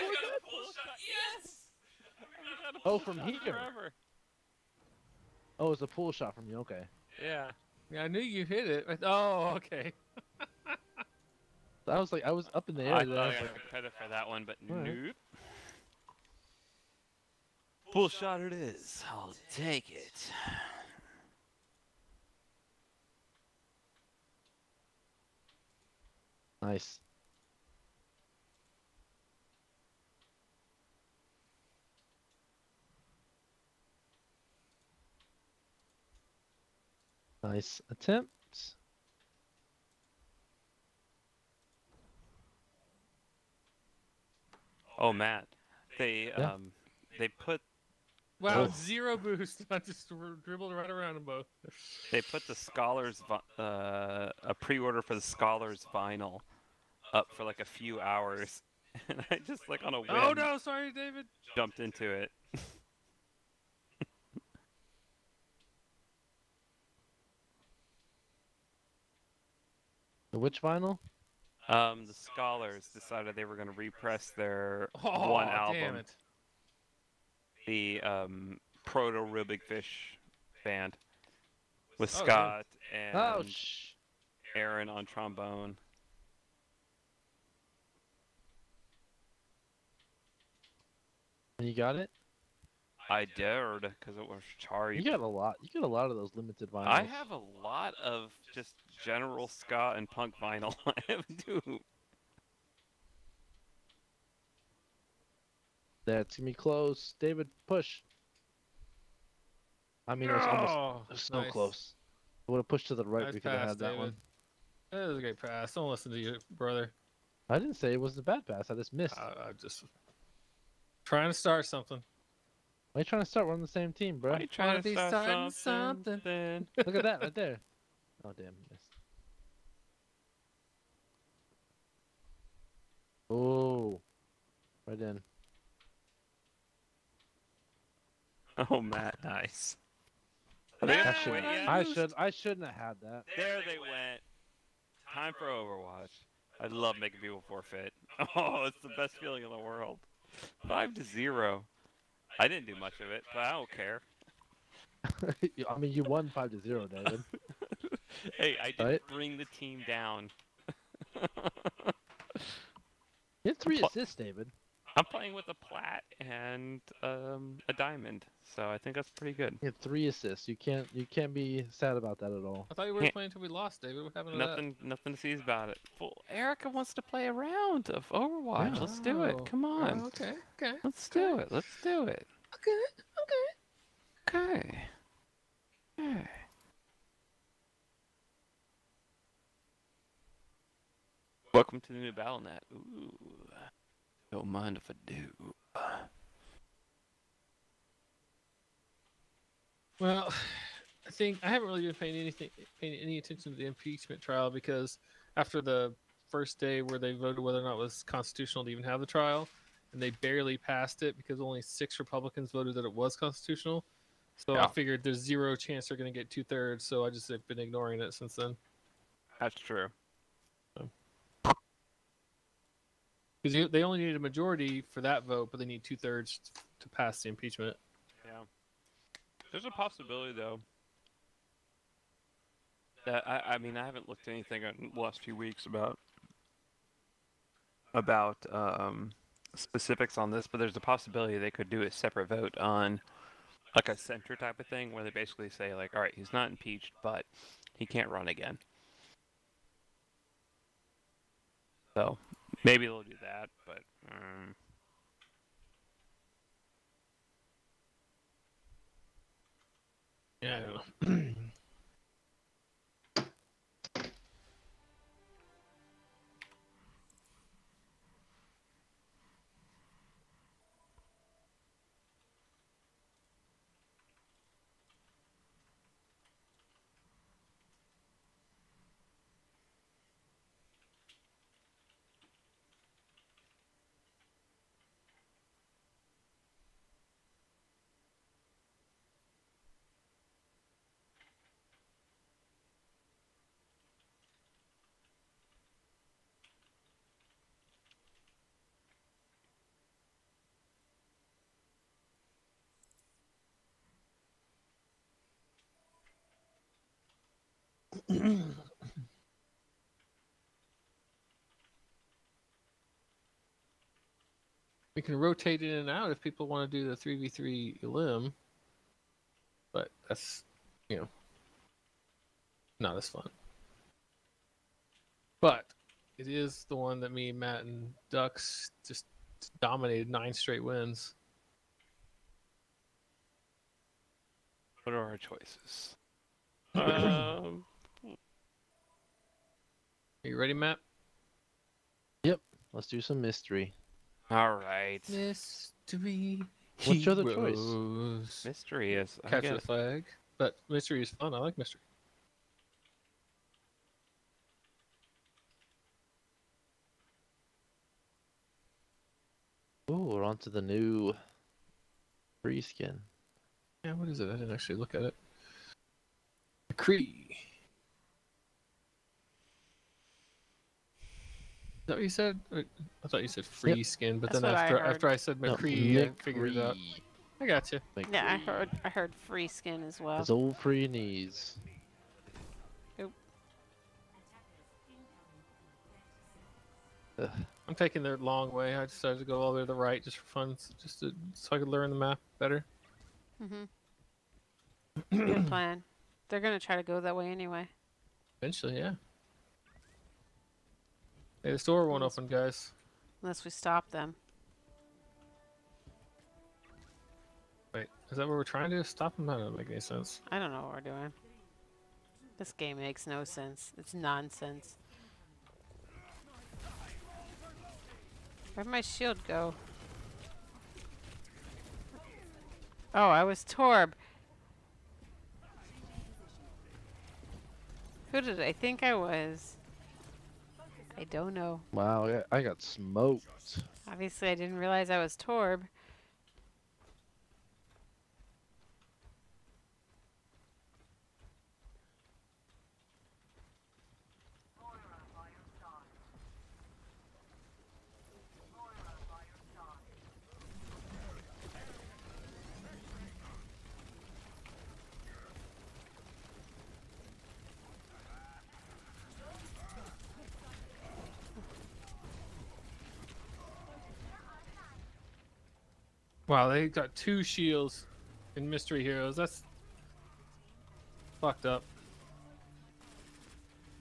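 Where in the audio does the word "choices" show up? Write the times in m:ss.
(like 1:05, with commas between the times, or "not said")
5:35, 5:47.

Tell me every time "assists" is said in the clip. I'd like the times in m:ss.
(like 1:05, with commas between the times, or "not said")
2:43, 2:50.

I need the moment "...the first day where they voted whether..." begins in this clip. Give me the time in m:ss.
3:25.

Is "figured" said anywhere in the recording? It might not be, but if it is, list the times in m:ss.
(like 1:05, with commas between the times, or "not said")
3:34, 6:16.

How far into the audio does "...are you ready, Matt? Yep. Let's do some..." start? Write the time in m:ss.
5:40.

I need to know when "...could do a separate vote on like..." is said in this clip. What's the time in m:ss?
4:01.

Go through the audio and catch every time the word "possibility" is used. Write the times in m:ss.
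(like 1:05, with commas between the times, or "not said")
3:49, 4:00.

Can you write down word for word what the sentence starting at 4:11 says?
So Maybe they'll do that, but.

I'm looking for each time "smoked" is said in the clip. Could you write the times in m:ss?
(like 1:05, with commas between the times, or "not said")
7:12.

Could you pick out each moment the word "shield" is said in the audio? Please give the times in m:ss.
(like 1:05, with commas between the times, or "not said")
6:58, 7:47.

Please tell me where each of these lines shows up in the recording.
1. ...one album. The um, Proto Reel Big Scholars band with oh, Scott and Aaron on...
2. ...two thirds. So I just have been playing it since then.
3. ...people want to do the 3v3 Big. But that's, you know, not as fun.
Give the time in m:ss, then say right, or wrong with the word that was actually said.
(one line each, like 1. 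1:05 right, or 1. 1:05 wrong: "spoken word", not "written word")
1. 1:15 wrong: "Fish", not "Scholars"
2. 3:36 wrong: "ignoring", not "playing"
3. 5:16 wrong: "Elim", not "Big".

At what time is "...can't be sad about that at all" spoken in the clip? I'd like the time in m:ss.
2:51.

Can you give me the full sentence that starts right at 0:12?
I thought I was like, credit for that one, but right.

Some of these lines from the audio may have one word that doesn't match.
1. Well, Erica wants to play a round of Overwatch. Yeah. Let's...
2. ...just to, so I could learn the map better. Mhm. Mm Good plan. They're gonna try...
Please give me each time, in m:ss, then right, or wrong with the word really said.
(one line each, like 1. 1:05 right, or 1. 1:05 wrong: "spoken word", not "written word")
1. 2:55 right
2. 6:30 right.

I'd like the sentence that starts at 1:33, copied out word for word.
I dared because it was Chari.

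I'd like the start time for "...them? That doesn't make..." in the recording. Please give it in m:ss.
6:49.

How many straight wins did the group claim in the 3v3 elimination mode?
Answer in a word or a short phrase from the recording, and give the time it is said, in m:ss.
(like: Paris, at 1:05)
9, at 5:30.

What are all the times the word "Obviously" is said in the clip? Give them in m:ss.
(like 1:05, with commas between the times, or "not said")
7:13.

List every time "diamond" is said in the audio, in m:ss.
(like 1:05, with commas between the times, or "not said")
2:47.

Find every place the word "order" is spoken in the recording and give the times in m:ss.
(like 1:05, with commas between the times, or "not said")
0:54.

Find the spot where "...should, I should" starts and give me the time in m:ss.
2:21.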